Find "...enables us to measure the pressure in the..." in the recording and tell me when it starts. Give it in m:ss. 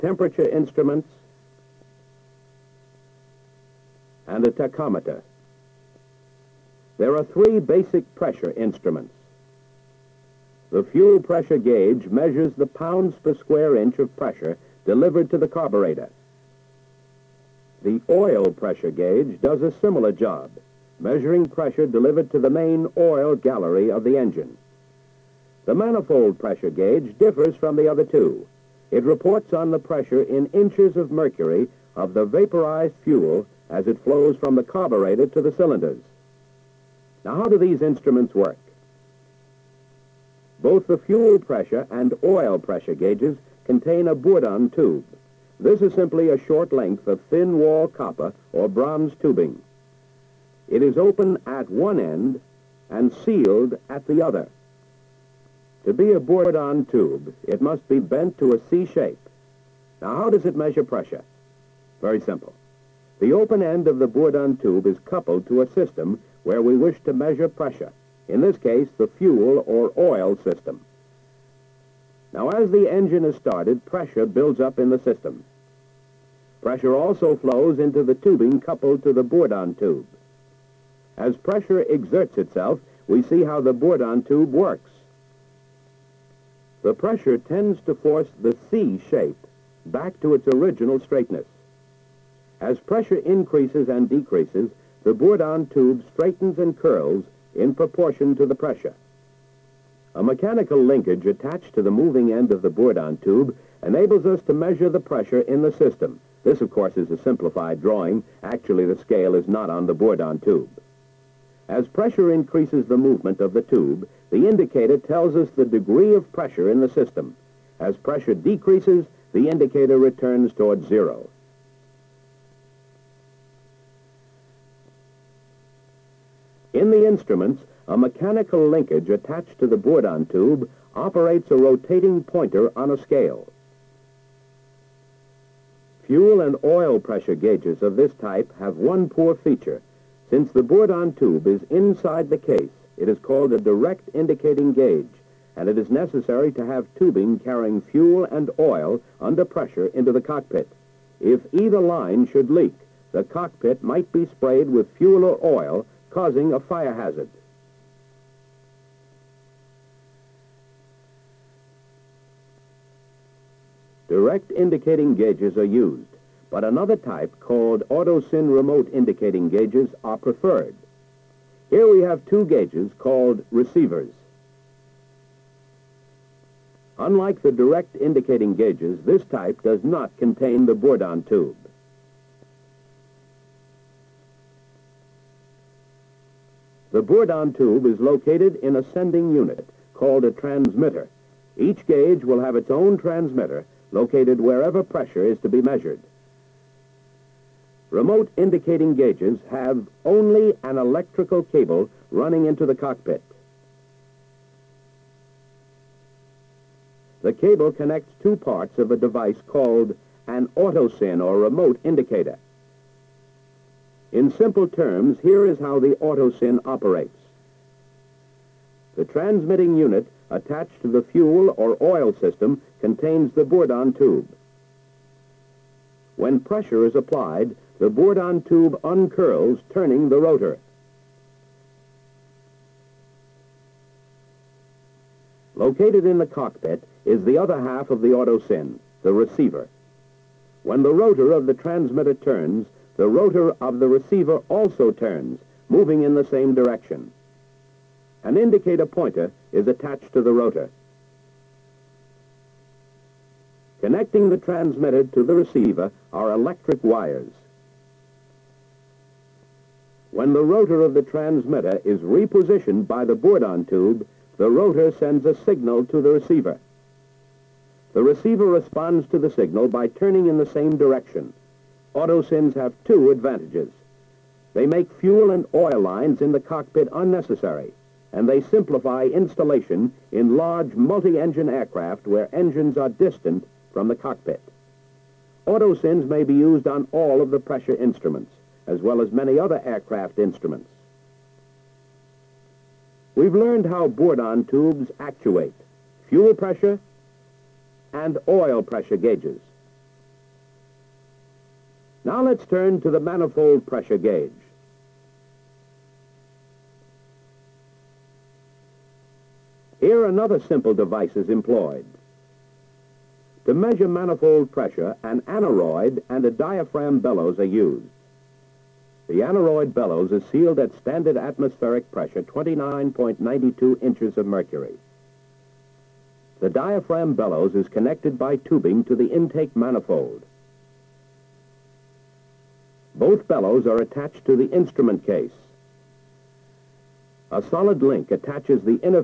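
1:43.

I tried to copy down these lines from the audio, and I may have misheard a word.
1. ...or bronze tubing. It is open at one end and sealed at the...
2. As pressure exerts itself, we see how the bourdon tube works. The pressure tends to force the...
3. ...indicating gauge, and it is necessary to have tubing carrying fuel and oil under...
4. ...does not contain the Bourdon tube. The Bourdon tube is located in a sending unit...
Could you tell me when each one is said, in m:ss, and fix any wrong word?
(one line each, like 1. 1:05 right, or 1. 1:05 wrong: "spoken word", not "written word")
1. 0:48 right
2. 1:21 right
3. 2:24 right
4. 2:59 right.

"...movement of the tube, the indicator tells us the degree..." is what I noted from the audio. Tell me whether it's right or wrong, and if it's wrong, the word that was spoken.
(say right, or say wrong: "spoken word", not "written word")
right.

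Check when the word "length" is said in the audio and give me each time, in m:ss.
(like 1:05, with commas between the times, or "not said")
0:46.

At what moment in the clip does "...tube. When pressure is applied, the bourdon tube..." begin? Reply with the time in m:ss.
3:43.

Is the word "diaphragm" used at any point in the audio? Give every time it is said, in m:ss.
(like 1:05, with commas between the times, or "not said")
5:16, 5:26.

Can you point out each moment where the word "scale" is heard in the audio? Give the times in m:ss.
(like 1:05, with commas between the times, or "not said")
1:48, 2:12.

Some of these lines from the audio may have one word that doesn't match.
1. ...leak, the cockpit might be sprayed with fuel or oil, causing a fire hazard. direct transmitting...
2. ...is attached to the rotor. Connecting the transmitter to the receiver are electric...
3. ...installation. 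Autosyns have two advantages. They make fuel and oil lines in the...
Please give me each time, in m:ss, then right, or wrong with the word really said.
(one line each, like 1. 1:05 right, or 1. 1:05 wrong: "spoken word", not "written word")
1. 2:32 wrong: "indicating", not "transmitting"
2. 4:09 right
3. 4:30 wrong: "direction", not "installation".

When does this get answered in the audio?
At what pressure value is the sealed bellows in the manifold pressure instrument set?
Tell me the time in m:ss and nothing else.
5:22.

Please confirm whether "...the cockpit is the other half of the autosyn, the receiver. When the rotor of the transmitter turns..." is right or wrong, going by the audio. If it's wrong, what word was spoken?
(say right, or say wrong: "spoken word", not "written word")
right.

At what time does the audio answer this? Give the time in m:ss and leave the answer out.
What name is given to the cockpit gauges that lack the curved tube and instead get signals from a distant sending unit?
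2:53.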